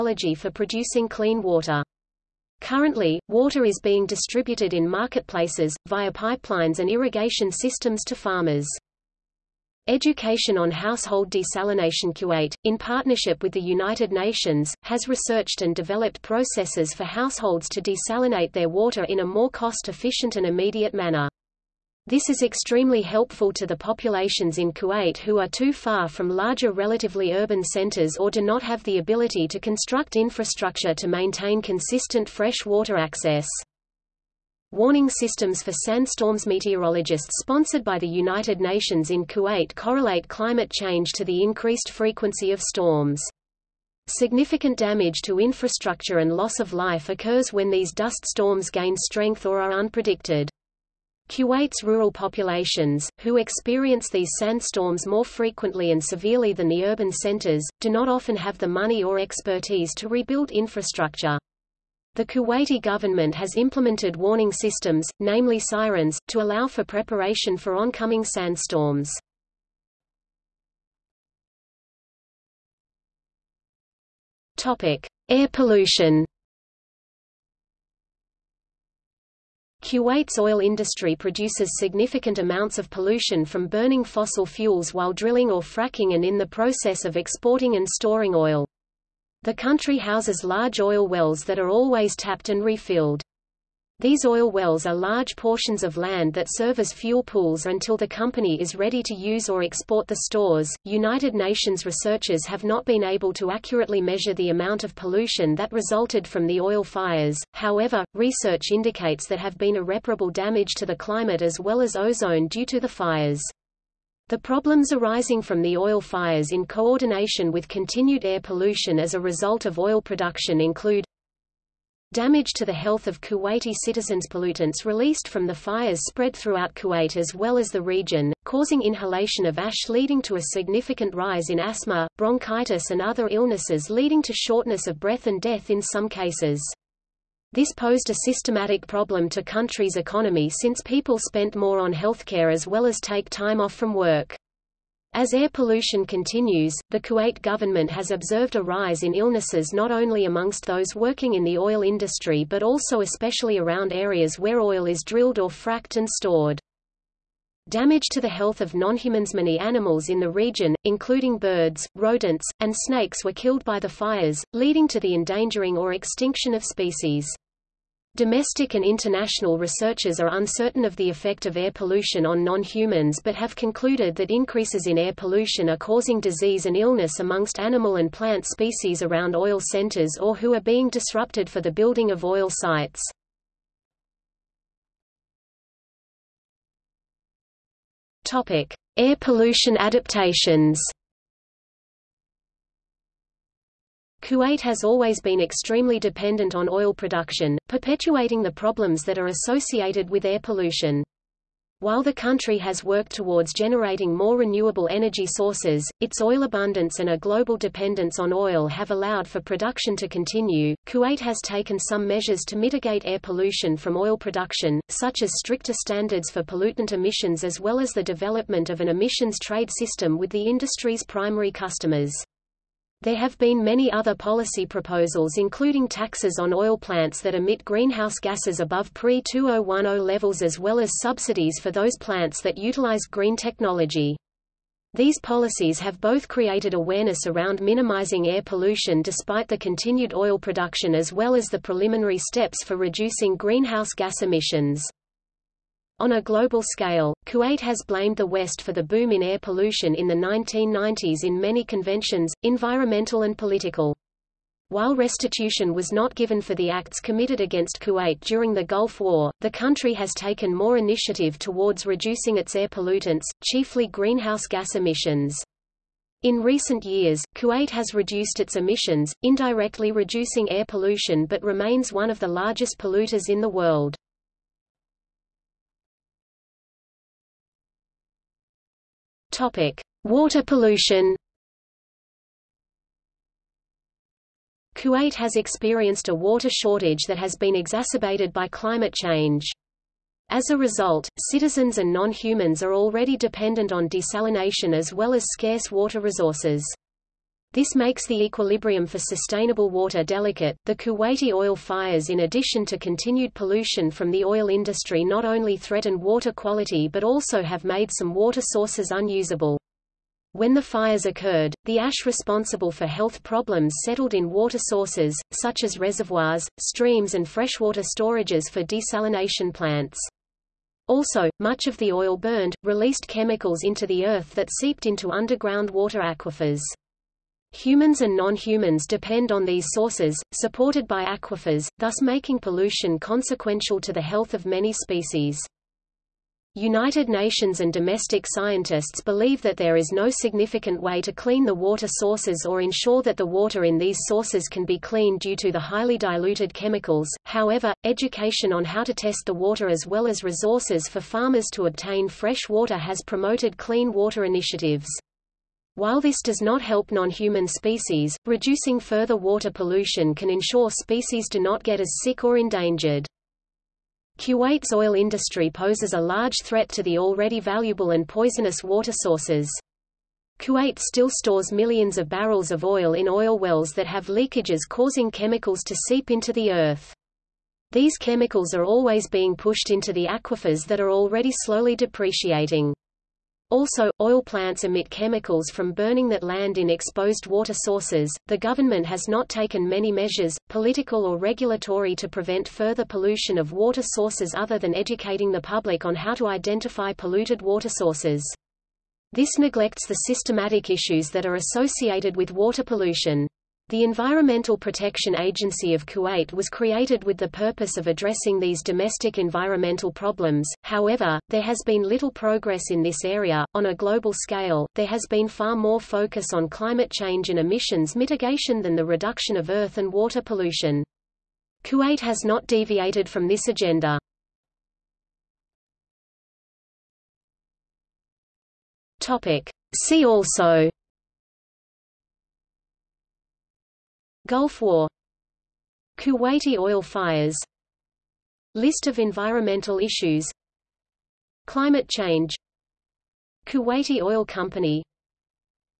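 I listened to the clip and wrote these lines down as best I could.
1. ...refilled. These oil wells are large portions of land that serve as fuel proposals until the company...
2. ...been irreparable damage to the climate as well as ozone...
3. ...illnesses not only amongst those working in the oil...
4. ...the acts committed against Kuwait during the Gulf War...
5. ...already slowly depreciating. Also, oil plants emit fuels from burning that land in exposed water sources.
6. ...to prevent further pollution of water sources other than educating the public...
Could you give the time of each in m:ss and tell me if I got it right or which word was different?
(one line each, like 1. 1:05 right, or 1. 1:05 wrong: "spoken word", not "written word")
1. 1:32 wrong: "pools", not "proposals"
2. 1:49 right
3. 2:29 right
4. 4:16 right
5. 6:20 wrong: "chemicals", not "fuels"
6. 6:31 right.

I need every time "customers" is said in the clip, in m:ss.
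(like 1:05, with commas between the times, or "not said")
3:41.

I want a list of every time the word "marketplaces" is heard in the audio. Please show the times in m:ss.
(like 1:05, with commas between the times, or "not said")
0:04.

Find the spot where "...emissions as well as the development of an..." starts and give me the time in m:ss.
3:36.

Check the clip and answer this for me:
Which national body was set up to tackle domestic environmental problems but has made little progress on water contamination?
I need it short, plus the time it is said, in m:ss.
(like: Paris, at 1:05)
Environmental Protection Agency of Kuwait, at 6:43.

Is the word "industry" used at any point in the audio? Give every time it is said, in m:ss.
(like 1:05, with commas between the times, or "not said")
1:20, 2:31, 3:40, 5:04, 6:04.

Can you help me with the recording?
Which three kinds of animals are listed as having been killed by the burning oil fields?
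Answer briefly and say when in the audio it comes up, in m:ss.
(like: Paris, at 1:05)
Birds, rodents, and snakes, at 2:41.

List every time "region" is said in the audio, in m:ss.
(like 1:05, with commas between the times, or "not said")
2:07, 2:40.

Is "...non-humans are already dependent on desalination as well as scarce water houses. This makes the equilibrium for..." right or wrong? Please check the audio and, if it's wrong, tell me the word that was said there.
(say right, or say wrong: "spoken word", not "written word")
wrong: "resources", not "houses".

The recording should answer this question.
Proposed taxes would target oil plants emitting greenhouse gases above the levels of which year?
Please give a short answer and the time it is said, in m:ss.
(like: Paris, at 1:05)
2010, at 3:48.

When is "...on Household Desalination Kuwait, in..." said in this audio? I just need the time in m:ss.
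0:10.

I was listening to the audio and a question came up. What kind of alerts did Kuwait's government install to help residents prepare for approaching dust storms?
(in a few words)
Sirens.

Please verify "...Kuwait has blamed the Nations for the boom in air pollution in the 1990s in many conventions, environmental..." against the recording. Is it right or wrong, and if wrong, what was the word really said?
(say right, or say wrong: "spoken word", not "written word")
wrong: "West", not "Nations".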